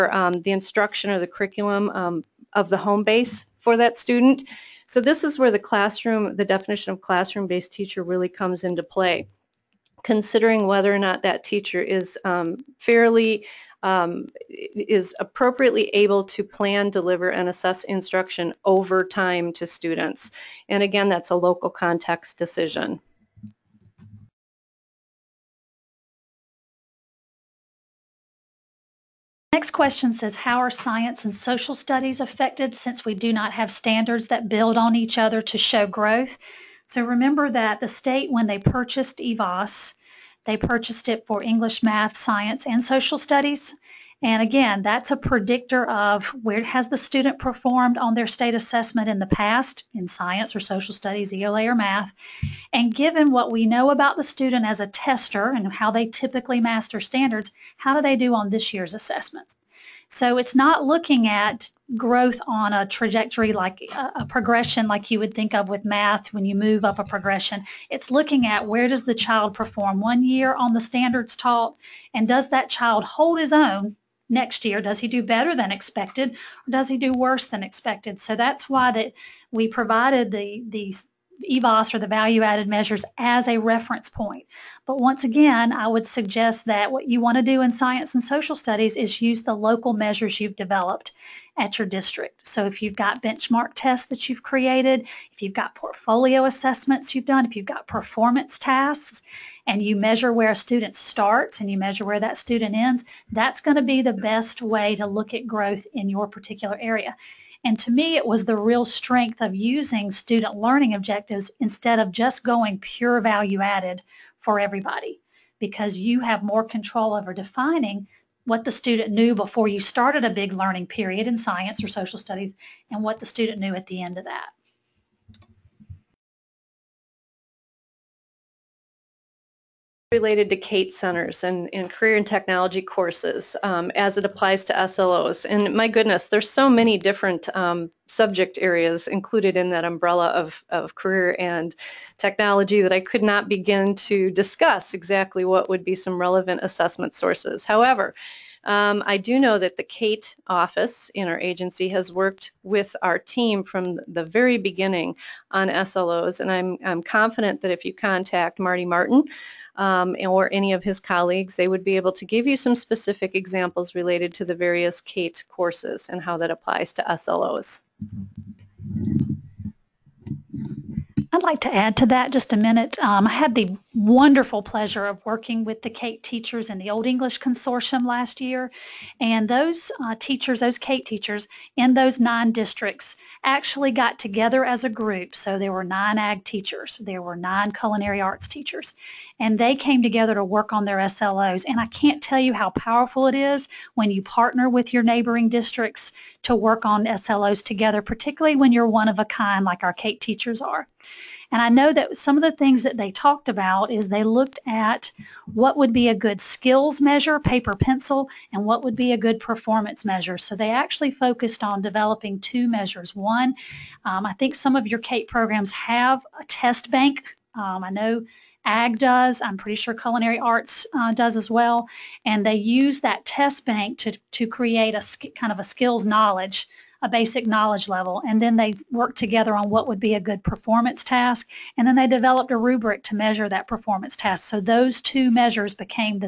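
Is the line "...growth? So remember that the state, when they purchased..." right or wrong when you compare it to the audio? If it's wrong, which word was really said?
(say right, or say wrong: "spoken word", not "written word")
right.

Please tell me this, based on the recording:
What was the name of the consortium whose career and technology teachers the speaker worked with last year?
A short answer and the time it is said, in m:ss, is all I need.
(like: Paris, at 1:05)
Olde English Consortium, at 2:56.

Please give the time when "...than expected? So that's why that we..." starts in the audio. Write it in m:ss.
1:17.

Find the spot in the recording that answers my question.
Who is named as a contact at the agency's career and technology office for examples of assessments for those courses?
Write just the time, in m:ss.
2:38.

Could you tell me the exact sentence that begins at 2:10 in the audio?
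related to CATE centers and, and career and technology courses um, as it applies to SLOs.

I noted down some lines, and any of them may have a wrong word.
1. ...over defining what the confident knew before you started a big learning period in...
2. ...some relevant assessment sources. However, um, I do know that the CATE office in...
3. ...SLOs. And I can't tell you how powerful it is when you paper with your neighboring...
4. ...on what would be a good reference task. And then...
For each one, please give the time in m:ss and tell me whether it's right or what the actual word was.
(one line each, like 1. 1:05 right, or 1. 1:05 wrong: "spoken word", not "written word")
1. 1:57 wrong: "student", not "confident"
2. 2:25 right
3. 3:10 wrong: "partner", not "paper"
4. 3:49 wrong: "performance", not "reference".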